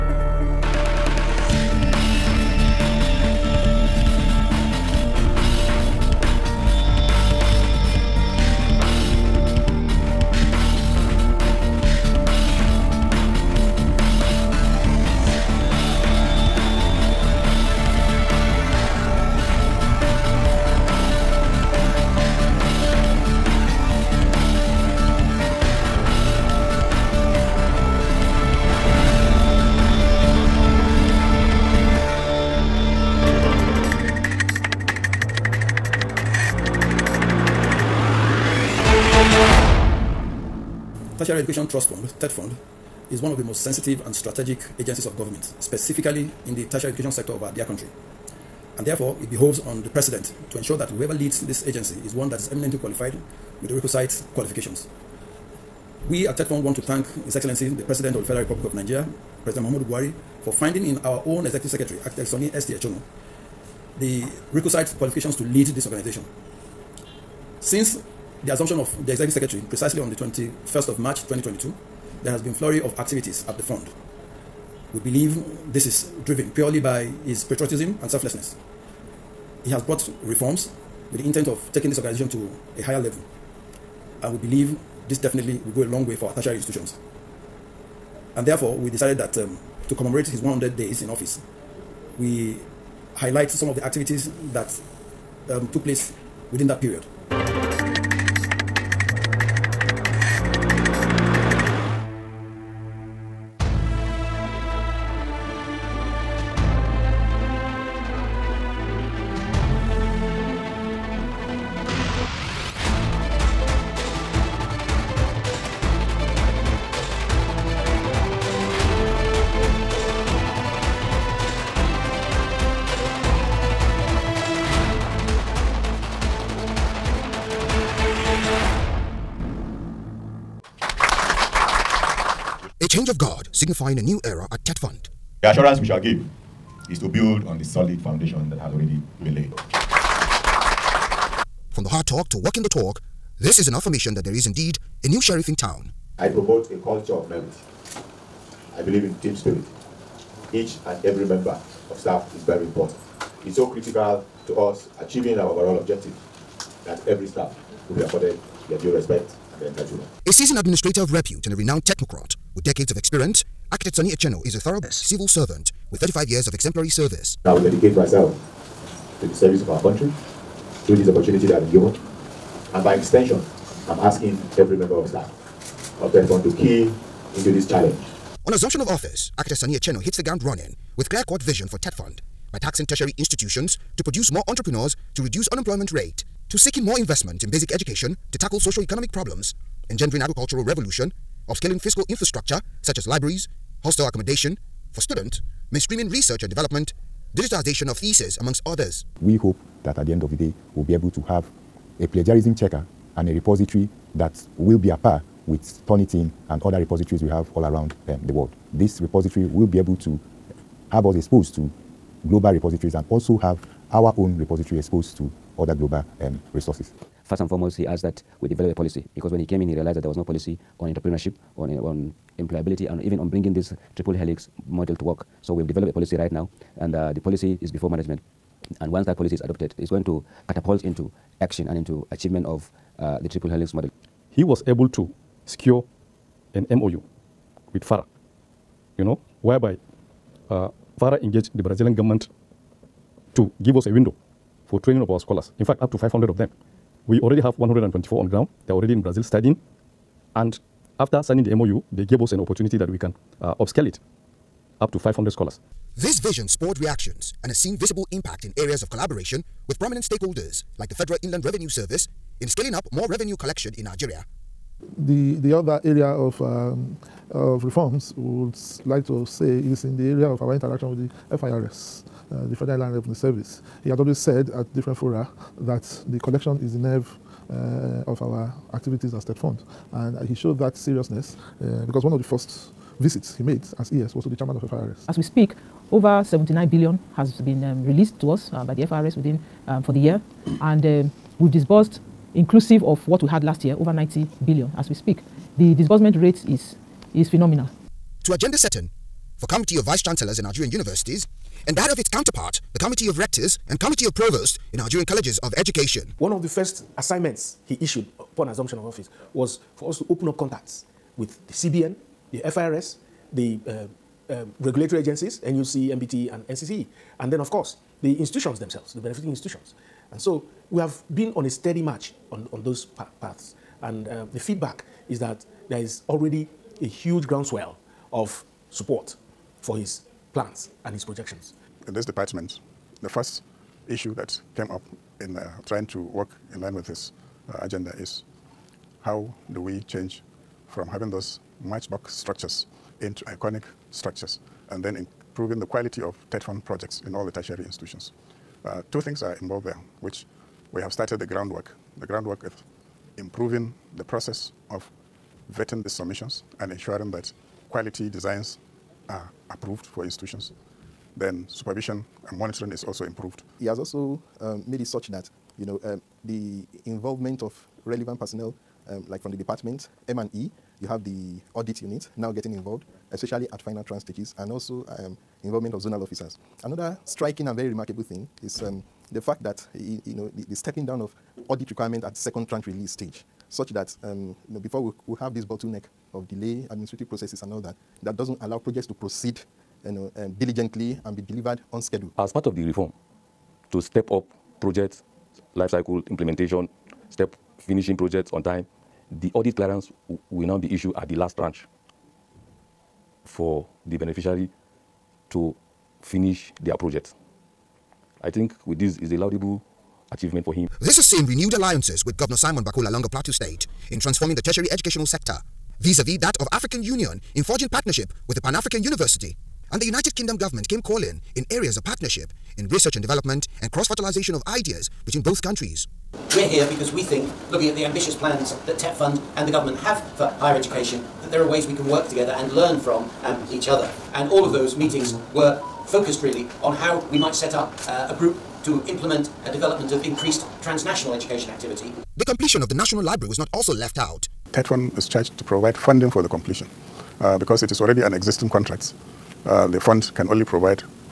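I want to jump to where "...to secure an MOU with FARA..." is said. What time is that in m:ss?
3:54.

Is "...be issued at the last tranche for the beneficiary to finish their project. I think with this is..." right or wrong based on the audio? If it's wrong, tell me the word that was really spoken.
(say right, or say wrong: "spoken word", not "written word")
right.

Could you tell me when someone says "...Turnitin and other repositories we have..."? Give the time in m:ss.
3:25.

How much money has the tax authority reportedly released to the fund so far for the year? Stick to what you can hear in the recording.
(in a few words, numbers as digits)
79 billion.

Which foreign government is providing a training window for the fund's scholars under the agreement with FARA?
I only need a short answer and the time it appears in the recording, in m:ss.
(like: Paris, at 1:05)
Brazilian government, at 4:01.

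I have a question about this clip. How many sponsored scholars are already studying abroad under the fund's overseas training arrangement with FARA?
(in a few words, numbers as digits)
124.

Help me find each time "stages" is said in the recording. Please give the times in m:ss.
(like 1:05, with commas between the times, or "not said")
6:14, 6:22.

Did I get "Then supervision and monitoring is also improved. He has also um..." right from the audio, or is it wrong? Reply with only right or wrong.
right.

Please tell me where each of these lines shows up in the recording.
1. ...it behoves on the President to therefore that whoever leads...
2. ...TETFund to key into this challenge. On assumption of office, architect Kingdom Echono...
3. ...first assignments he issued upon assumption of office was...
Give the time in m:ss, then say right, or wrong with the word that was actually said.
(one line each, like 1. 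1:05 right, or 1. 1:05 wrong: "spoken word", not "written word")
1. 0:49 wrong: "ensure", not "therefore"
2. 2:56 wrong: "Sonny", not "Kingdom"
3. 5:06 right.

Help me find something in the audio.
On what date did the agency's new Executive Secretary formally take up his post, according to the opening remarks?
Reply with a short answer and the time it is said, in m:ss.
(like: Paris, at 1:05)
21st of March 2022, at 1:10.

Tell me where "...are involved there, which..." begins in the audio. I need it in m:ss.
5:49.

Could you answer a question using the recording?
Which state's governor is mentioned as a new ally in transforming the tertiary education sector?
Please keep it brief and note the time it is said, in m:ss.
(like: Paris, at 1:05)
Plateau State, at 6:53.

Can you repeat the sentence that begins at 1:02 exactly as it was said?
Echono, the requisite qualifications to lead this organization.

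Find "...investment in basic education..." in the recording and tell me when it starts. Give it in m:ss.
3:06.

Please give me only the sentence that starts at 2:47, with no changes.
I will dedicate myself to the service of our country through this opportunity that I've been given.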